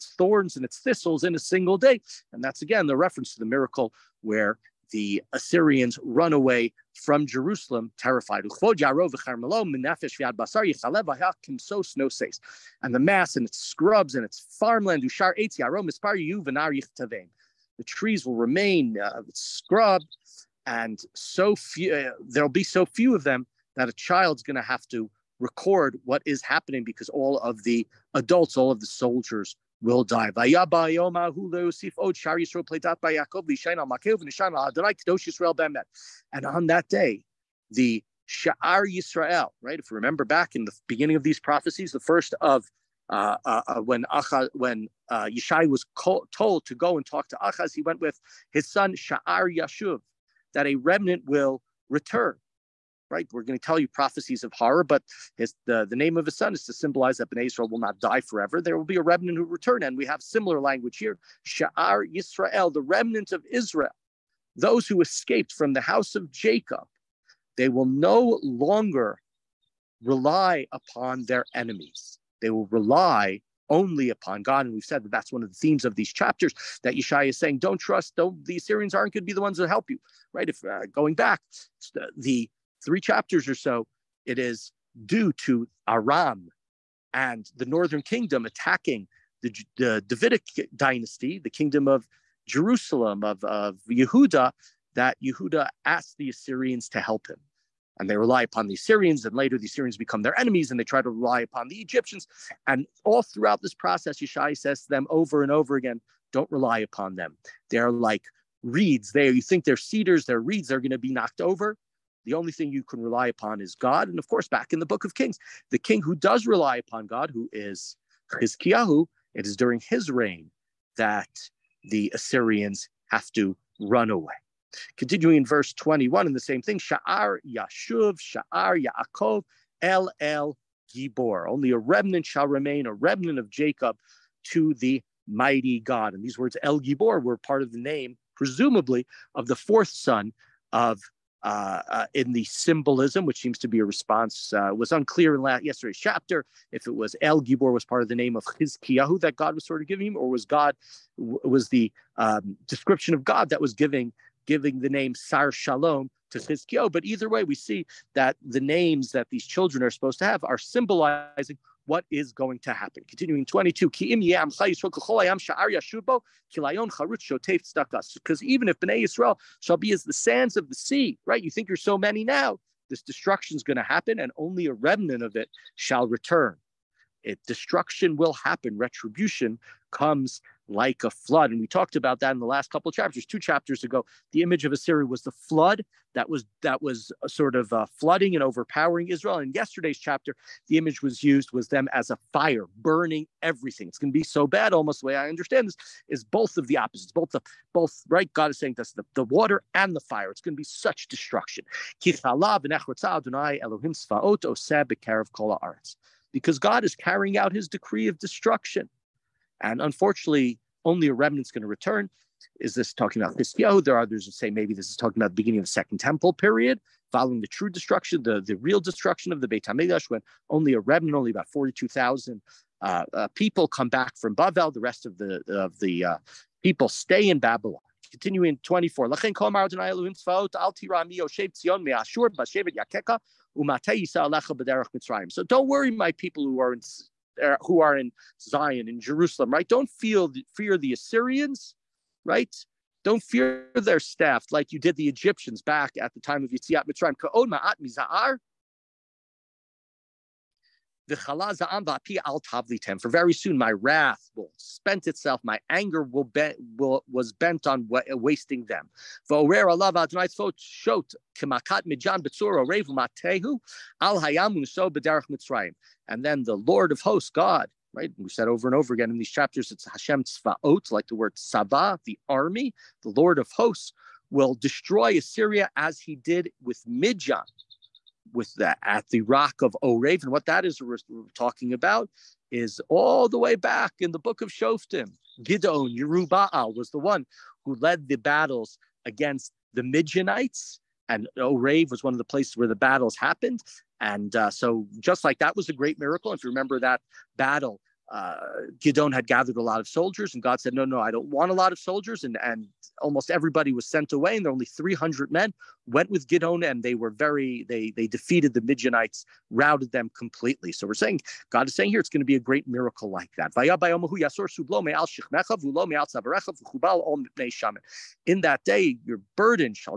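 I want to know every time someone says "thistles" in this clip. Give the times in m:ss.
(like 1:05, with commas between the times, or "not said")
0:00.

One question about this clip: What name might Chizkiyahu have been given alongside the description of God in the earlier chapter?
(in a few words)
Sar Shalom.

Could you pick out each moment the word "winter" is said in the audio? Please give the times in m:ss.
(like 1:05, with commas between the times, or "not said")
not said.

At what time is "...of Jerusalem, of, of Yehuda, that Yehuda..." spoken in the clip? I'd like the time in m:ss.
1:31.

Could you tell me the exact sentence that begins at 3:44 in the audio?
The rest of the of the uh, people stay in Babylon.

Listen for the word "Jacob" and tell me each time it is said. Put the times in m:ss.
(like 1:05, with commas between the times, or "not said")
1:06, 2:13.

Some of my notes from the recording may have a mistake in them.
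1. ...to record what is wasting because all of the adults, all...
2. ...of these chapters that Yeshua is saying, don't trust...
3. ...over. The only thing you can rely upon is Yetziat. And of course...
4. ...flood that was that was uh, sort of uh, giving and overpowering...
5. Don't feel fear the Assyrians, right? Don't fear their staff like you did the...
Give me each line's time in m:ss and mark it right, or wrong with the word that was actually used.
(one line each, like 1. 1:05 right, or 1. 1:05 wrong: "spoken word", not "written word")
1. 0:24 wrong: "happening", not "wasting"
2. 1:15 right
3. 1:51 wrong: "God", not "Yetziat"
4. 3:05 wrong: "flooding", not "giving"
5. 3:59 right.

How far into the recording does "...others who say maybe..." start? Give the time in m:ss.
3:34.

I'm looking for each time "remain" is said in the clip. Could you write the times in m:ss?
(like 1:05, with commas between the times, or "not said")
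0:18, 2:12.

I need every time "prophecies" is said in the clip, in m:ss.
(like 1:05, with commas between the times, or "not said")
0:41, 0:53.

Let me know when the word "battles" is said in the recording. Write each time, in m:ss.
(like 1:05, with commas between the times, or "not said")
4:48, 4:52, 4:57.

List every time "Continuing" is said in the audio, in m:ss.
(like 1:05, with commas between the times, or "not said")
2:04, 2:43, 3:48.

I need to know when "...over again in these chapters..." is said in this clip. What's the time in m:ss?
4:28.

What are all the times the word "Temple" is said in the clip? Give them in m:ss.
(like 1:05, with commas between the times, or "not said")
3:35.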